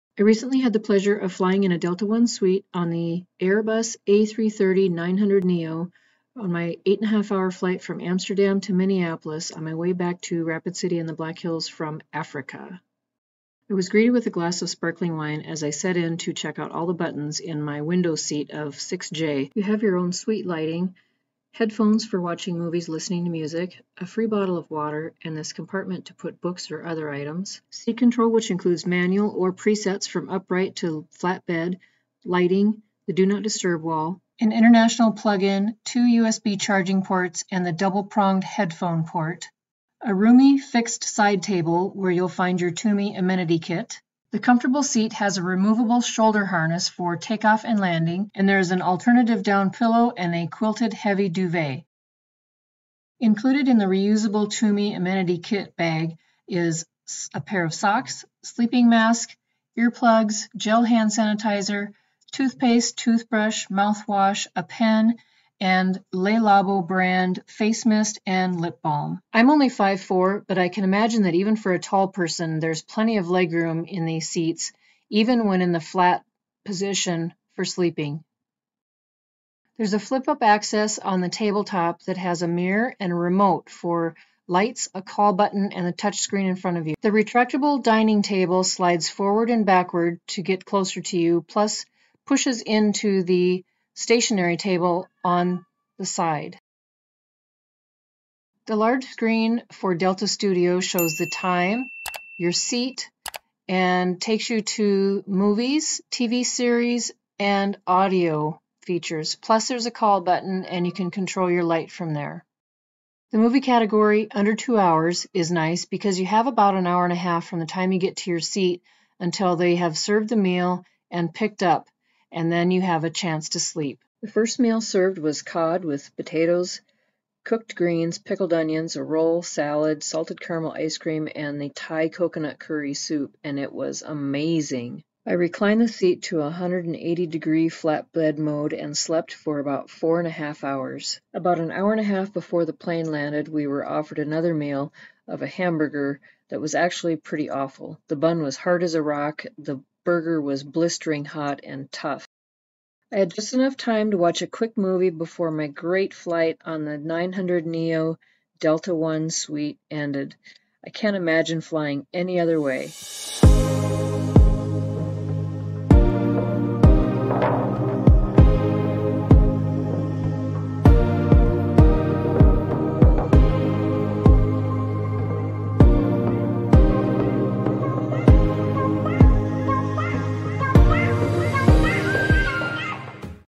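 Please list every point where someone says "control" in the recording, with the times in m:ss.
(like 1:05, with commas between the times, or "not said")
0:27, 1:51.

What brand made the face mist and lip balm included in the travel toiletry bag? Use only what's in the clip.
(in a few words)
Le Labo.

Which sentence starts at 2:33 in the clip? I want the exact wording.
I had just enough time to watch a quick movie before my great flight on the 900 Neo Delta One suite ended.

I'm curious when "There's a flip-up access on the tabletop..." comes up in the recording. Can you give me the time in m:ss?
1:19.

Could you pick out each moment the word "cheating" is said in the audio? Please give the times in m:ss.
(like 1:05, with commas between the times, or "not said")
not said.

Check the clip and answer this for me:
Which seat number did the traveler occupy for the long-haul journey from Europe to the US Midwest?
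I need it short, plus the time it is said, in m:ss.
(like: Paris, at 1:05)
6J, at 0:18.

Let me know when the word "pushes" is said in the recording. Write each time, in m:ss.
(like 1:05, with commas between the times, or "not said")
1:32.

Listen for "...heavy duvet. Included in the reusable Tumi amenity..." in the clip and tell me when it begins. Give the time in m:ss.
0:50.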